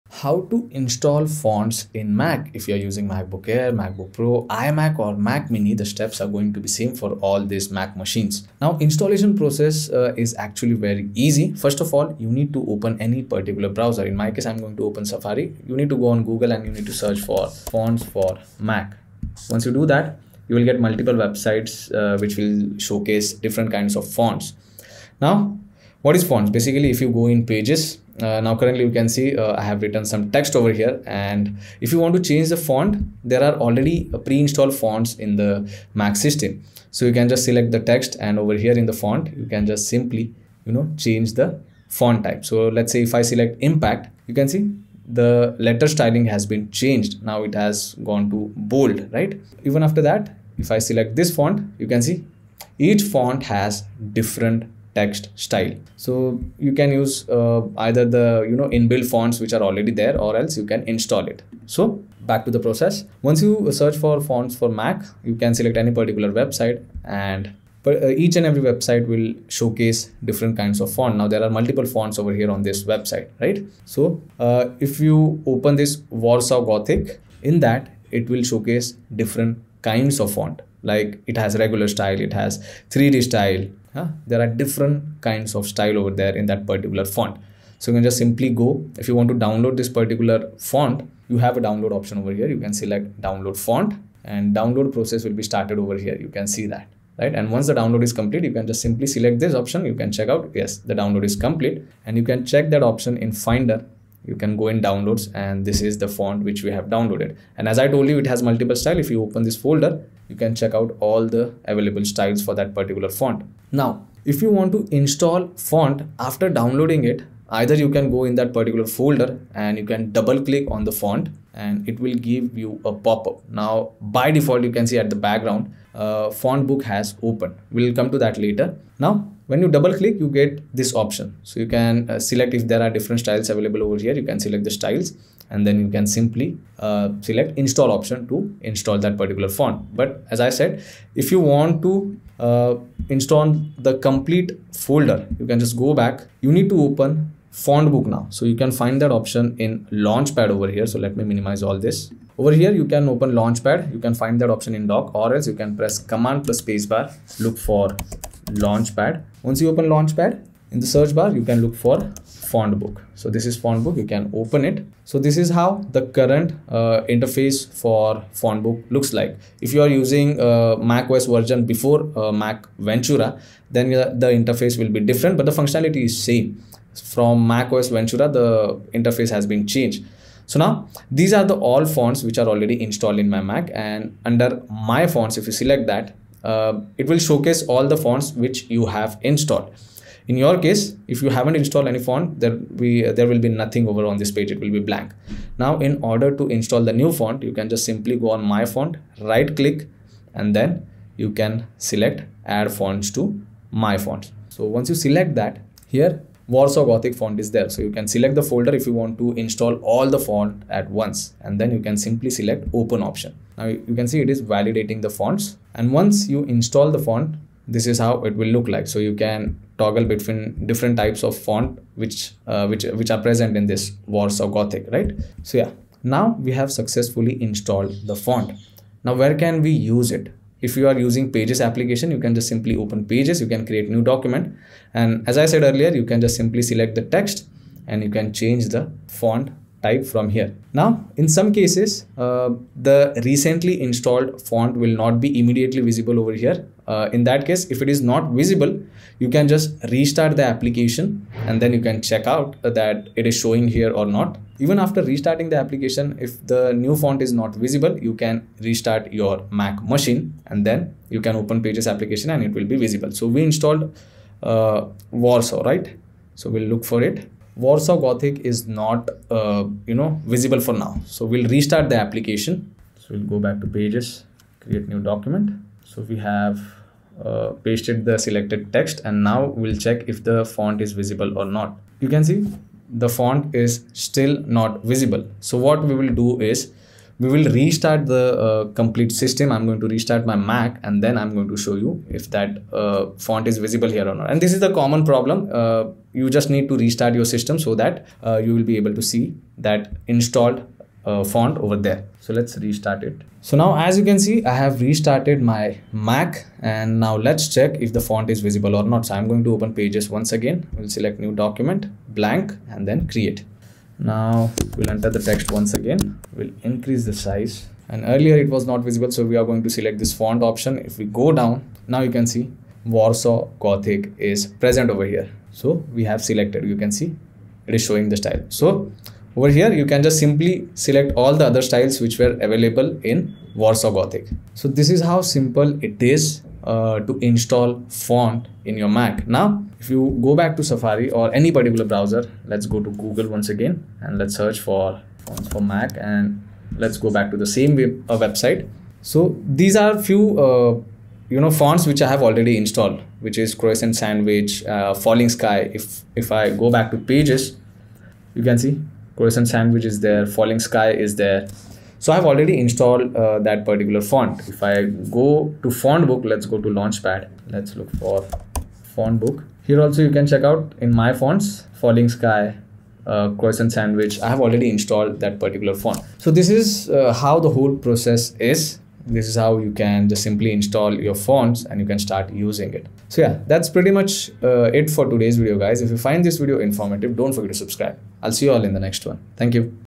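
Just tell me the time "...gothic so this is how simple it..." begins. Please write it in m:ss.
5:33.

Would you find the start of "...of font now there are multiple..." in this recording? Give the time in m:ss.
1:10.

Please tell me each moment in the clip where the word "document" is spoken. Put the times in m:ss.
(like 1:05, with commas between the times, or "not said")
3:54, 4:34, 5:11.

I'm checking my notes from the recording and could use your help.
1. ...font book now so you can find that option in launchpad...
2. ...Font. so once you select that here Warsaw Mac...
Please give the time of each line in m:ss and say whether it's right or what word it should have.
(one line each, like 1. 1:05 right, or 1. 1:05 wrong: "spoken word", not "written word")
1. 2:27 right
2. 3:23 wrong: "Gothic", not "Mac".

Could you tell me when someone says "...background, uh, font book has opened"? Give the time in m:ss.
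2:05.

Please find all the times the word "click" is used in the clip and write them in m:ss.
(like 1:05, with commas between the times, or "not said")
2:00, 2:09, 3:19.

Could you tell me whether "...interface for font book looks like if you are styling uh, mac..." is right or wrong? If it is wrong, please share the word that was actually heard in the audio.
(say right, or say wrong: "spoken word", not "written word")
wrong: "using", not "styling".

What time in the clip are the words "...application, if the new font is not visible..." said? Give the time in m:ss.
4:15.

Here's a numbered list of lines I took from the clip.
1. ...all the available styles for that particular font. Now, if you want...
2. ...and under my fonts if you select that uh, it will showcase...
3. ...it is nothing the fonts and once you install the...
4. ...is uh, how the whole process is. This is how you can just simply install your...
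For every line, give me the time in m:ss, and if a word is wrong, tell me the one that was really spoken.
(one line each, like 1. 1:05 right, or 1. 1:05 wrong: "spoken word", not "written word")
1. 1:51 right
2. 3:03 right
3. 3:34 wrong: "validating", not "nothing"
4. 6:16 right.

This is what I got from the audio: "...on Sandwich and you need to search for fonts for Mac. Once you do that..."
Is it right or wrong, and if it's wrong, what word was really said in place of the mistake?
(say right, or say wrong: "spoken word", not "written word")
wrong: "Google", not "Sandwich".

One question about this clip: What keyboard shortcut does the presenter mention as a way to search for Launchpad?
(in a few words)
Command plus spacebar.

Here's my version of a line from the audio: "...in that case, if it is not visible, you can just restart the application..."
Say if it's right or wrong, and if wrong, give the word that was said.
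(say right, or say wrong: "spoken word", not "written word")
right.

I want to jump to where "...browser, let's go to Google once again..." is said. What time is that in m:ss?
5:41.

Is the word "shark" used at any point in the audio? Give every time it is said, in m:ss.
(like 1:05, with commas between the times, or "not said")
not said.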